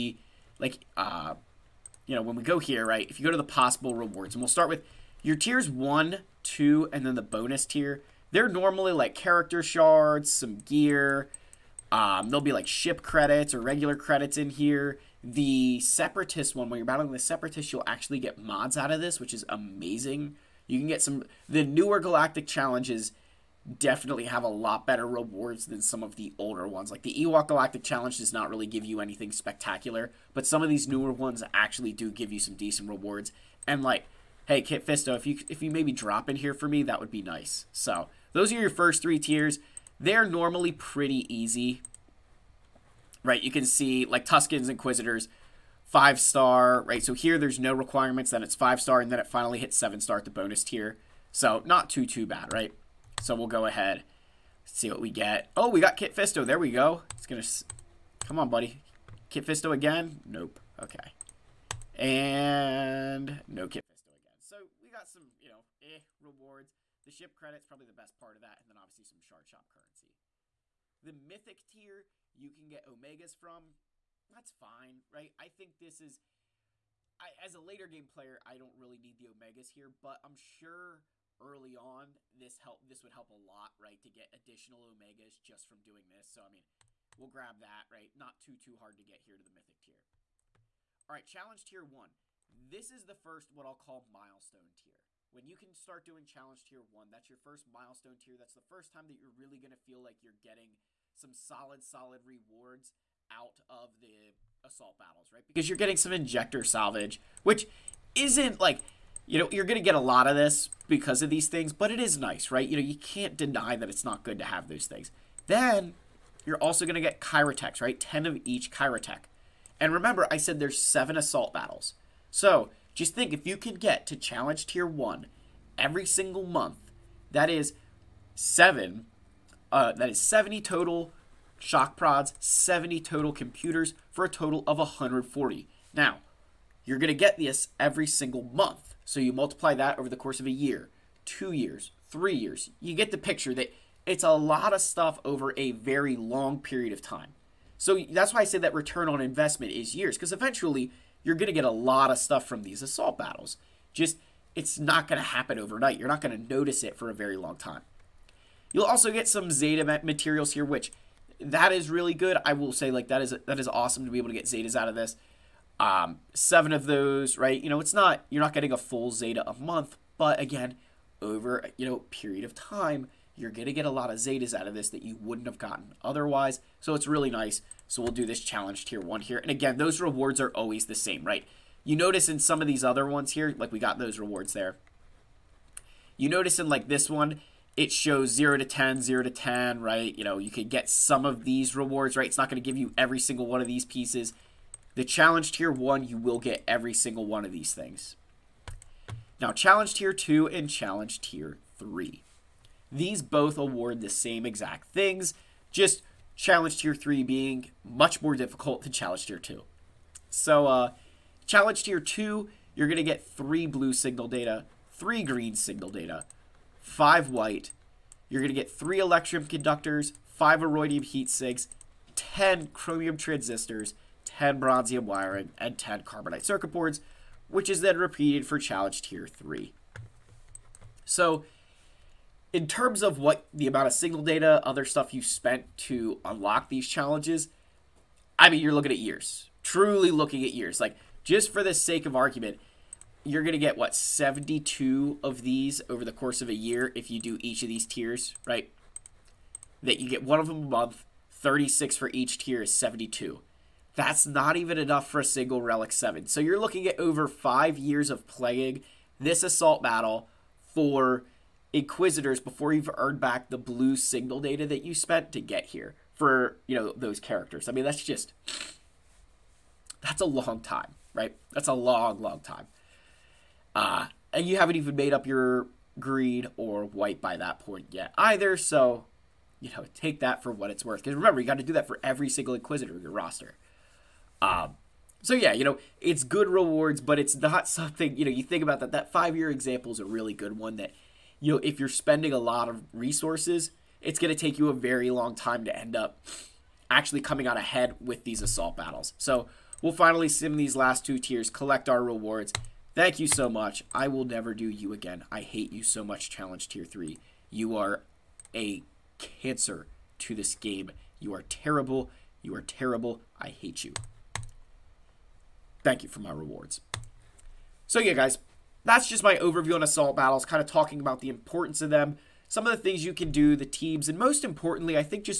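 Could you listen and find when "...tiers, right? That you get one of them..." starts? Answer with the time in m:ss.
4:07.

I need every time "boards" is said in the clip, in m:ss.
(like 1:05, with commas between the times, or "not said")
3:46.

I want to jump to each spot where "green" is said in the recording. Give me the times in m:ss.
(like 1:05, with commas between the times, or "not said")
3:35, 4:35.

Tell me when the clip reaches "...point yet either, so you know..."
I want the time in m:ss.
4:37.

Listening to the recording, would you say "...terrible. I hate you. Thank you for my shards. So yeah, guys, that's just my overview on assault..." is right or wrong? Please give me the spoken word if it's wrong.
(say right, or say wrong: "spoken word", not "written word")
wrong: "rewards", not "shards".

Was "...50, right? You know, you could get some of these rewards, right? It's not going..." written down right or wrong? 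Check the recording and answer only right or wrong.
wrong.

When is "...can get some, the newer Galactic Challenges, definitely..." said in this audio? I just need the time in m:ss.
0:20.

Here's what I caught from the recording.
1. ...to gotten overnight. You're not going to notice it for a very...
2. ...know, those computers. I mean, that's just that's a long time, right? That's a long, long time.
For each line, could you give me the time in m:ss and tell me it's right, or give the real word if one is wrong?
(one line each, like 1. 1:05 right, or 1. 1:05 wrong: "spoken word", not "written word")
1. 2:35 wrong: "happen", not "gotten"
2. 4:26 wrong: "characters", not "computers".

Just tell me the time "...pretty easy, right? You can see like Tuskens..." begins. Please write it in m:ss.
0:40.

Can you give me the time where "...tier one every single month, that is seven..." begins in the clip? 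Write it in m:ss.
2:04.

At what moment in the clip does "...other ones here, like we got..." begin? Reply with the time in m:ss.
3:02.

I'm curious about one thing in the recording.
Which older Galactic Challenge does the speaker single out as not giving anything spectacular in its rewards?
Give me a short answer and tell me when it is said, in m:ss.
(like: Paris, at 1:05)
Ewok, at 0:27.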